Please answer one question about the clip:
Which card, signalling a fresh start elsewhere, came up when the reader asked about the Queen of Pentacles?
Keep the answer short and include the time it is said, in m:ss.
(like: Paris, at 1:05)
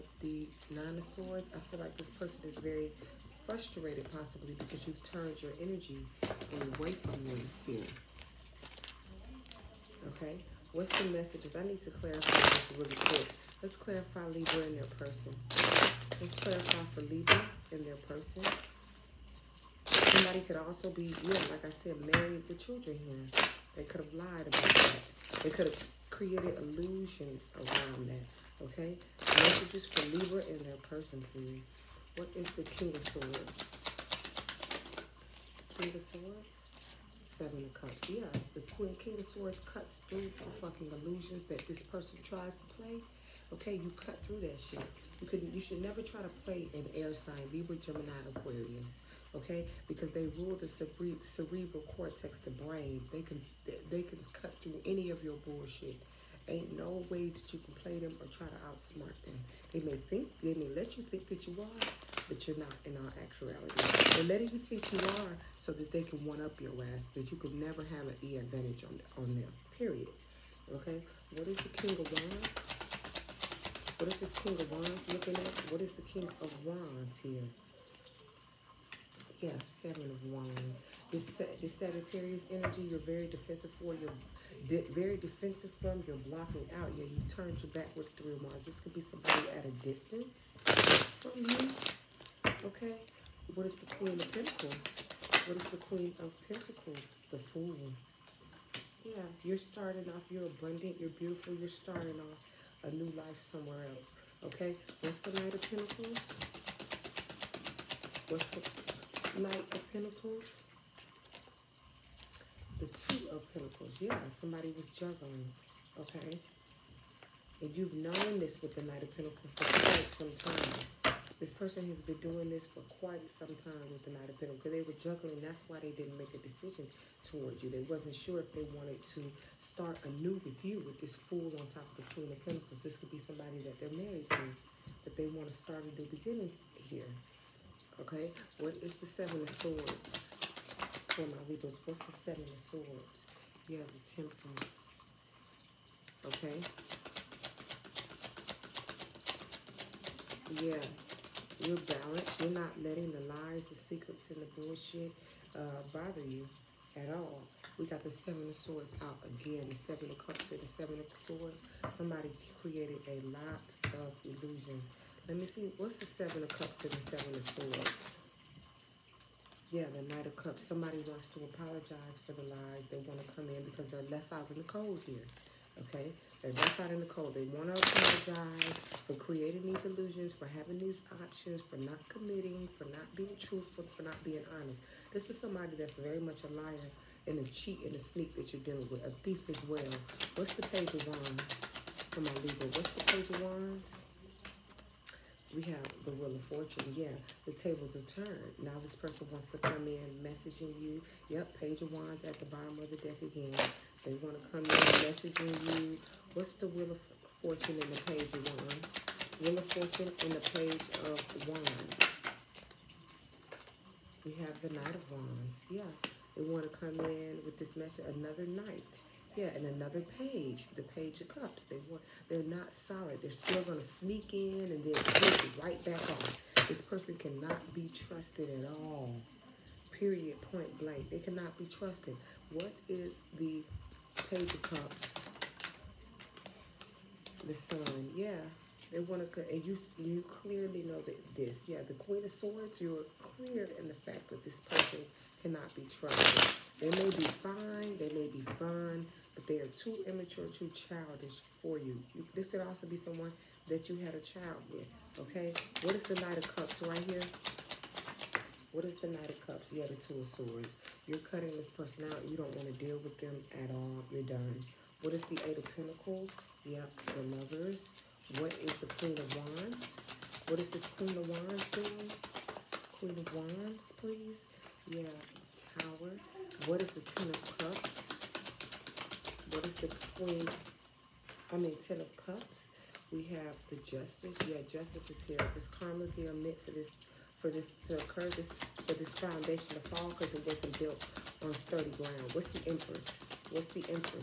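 The Fool, at 1:37.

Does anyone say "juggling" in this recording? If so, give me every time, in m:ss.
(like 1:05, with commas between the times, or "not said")
1:54, 2:05.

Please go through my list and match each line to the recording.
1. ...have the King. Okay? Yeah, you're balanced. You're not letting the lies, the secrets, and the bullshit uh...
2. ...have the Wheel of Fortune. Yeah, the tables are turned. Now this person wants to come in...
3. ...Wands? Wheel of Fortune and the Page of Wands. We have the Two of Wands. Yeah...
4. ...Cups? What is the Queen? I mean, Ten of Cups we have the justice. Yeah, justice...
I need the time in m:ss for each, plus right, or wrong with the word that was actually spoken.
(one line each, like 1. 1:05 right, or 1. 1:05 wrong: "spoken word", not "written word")
1. 2:23 wrong: "Temperance", not "King"
2. 3:15 right
3. 3:28 wrong: "Knight", not "Two"
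4. 4:37 right.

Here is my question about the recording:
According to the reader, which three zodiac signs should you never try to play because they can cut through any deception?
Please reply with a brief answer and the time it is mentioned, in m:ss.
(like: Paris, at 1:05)
Libra, Gemini, Aquarius, at 0:47.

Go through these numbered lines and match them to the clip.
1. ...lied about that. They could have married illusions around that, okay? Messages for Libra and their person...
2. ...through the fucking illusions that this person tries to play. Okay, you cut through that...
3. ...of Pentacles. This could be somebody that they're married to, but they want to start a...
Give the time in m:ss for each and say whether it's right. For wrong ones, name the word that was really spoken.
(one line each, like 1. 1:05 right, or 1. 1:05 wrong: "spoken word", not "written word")
1. 0:24 wrong: "created", not "married"
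2. 0:40 right
3. 2:12 right.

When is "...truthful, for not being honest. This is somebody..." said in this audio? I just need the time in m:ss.
3:03.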